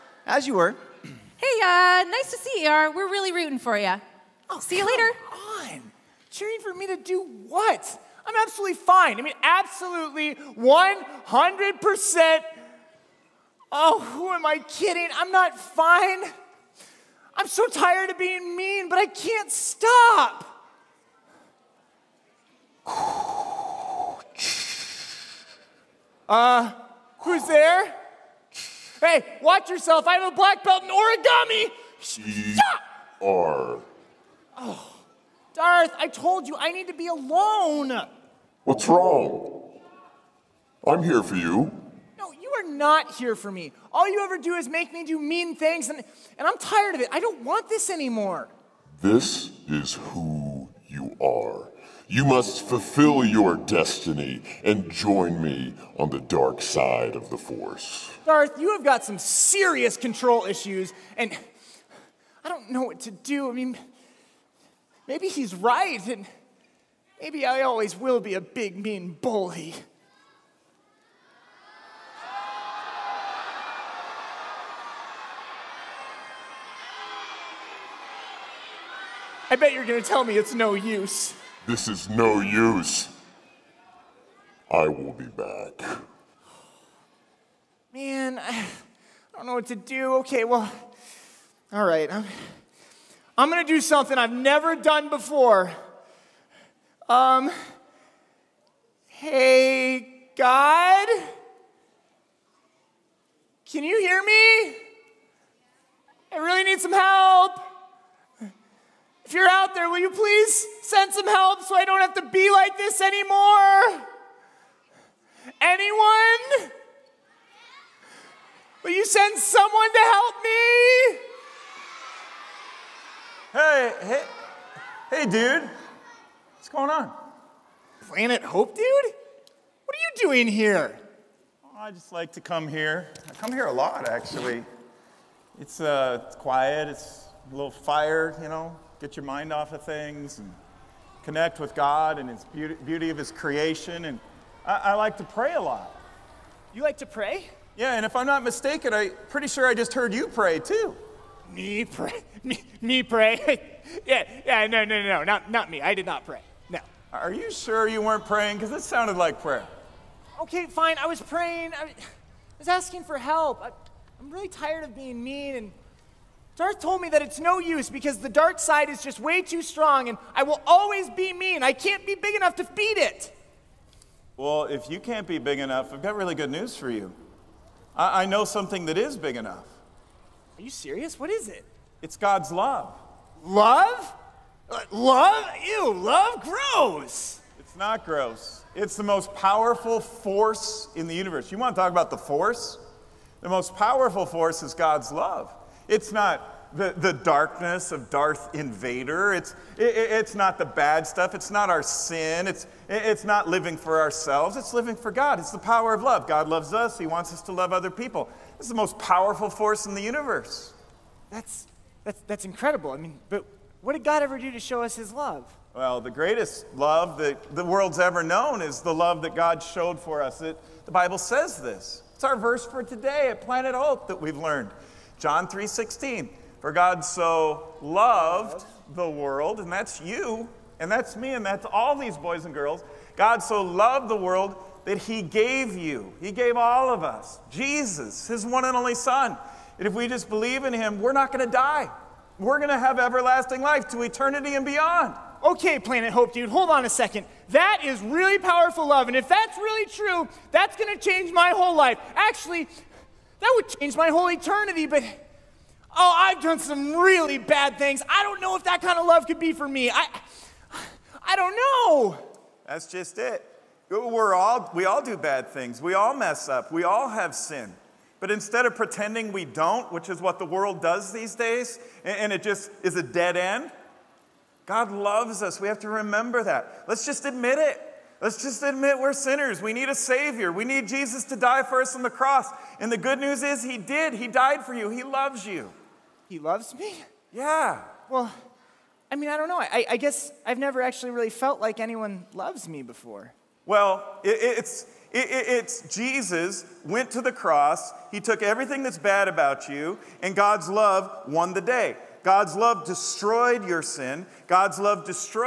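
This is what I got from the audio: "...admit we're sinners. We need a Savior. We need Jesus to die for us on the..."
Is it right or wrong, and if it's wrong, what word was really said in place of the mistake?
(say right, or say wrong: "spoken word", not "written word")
right.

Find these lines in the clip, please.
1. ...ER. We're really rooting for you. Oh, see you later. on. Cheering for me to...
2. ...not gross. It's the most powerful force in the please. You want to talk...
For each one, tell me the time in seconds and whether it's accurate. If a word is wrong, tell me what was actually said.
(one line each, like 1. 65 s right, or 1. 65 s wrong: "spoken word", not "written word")
1. 2 s right
2. 187 s wrong: "universe", not "please".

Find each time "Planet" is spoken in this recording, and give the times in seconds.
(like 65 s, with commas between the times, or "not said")
128 s, 223 s, 245 s.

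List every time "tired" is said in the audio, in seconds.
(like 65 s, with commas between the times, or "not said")
17 s, 46 s, 164 s.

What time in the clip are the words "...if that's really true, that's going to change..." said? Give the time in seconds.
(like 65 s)
249 s.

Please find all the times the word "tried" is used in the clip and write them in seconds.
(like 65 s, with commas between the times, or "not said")
not said.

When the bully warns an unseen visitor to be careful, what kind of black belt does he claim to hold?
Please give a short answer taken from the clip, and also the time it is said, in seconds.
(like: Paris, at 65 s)
Origami, at 30 s.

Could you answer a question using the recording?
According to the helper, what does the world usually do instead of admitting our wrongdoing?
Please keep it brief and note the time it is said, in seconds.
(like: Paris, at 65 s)
Pretending we don't, at 268 s.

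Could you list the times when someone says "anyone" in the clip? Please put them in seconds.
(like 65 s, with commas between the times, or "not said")
115 s, 291 s.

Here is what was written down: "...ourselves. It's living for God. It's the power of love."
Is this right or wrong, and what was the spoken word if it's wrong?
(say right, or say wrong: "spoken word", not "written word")
right.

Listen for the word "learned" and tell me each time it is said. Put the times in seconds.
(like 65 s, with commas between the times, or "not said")
224 s.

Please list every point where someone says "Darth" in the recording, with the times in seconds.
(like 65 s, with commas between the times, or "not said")
35 s, 58 s, 166 s, 198 s.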